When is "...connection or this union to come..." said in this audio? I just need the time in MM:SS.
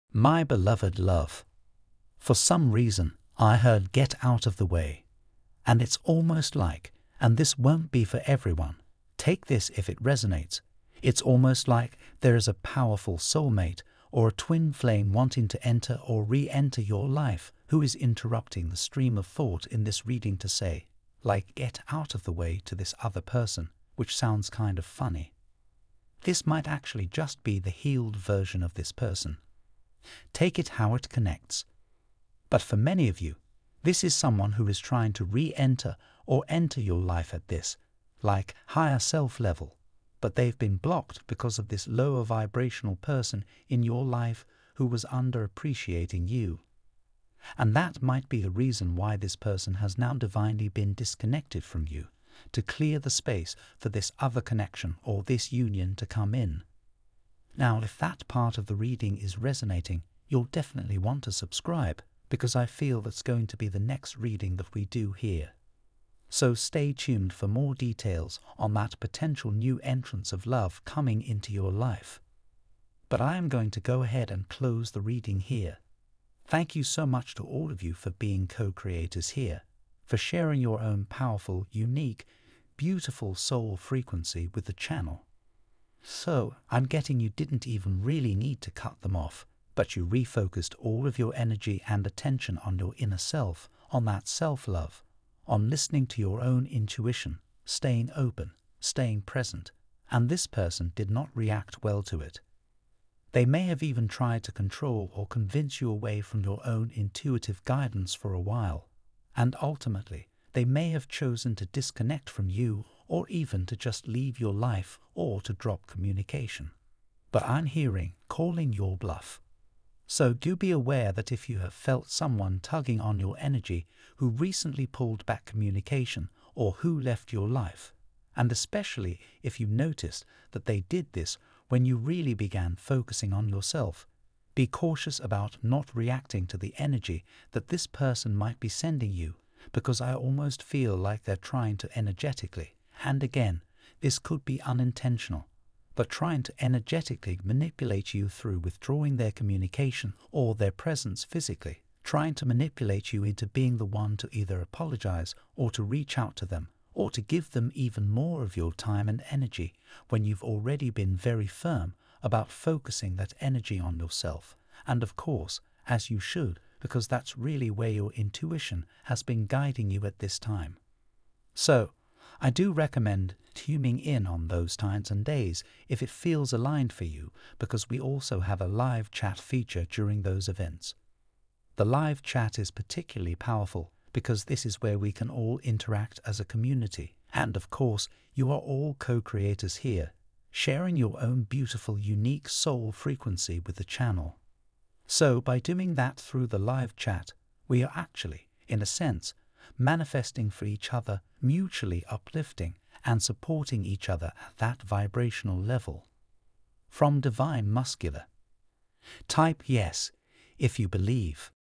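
00:54.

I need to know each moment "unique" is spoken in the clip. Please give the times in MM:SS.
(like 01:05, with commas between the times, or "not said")
01:21, 03:11.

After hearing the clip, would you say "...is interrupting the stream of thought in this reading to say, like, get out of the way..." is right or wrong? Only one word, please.
right.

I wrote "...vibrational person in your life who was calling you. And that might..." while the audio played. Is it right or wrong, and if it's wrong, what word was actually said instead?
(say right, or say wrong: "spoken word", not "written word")
wrong: "underappreciating", not "calling".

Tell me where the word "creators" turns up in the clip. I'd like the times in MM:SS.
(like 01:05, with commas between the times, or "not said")
01:18, 03:09.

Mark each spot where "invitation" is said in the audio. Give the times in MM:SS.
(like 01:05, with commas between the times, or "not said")
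not said.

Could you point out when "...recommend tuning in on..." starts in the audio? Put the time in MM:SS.
02:52.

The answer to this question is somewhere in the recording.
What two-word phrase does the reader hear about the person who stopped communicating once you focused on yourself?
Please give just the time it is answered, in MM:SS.
01:58.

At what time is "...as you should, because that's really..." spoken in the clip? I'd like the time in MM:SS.
02:45.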